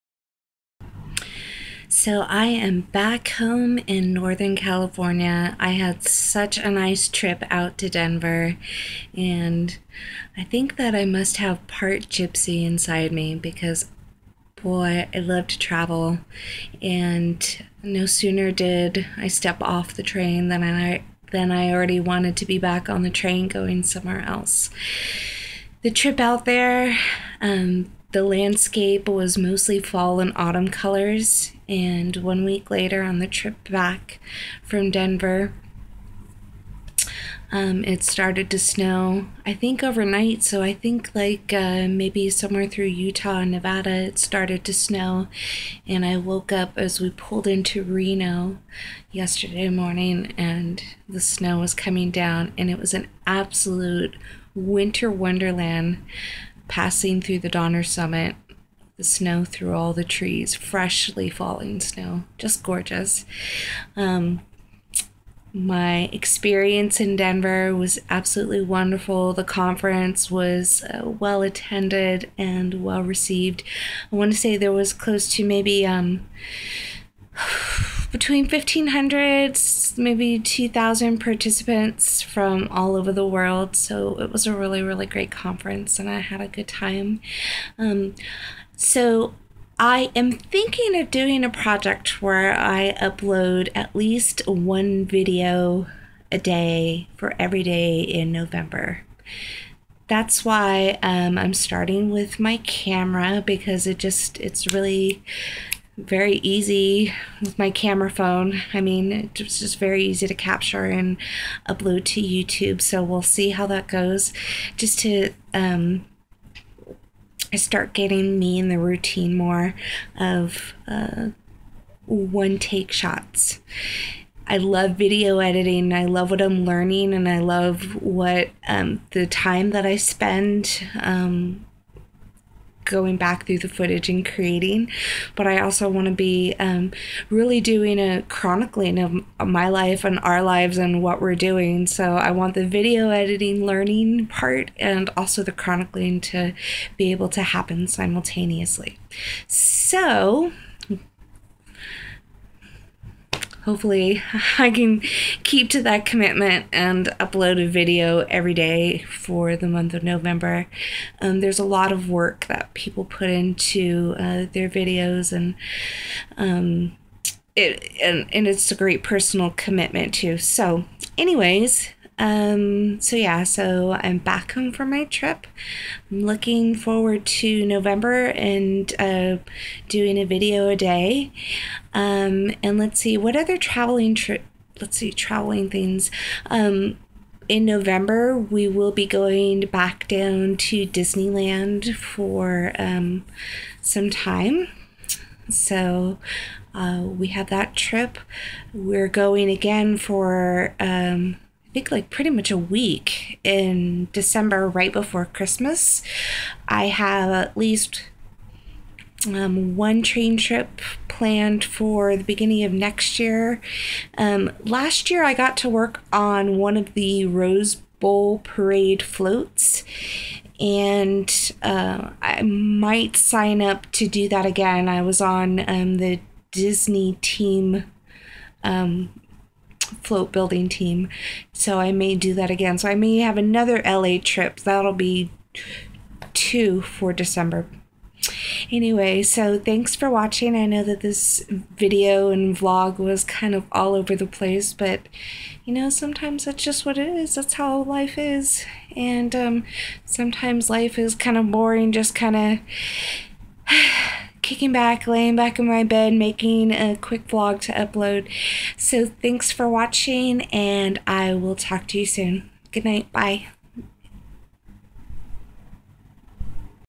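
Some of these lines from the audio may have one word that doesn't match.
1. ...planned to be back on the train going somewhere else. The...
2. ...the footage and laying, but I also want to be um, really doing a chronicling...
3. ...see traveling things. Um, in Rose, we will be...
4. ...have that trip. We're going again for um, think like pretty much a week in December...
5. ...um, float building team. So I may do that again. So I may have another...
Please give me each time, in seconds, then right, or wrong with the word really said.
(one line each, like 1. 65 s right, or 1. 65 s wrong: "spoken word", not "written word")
1. 21 s wrong: "wanted", not "planned"
2. 133 s wrong: "creating", not "laying"
3. 184 s wrong: "November", not "Rose"
4. 197 s right
5. 228 s right.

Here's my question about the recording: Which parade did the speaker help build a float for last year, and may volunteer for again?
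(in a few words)
Rose Bowl parade.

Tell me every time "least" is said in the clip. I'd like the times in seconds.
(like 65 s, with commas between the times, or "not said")
93 s, 207 s.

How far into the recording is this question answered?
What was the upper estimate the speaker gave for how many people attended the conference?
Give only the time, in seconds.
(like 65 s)
80 s.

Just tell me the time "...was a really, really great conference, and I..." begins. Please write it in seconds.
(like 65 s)
84 s.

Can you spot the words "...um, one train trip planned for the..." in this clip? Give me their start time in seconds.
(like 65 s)
209 s.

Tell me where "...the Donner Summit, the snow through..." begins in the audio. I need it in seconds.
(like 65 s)
57 s.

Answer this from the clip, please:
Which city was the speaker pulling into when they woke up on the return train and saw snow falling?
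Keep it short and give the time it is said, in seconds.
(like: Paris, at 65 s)
Reno, at 47 s.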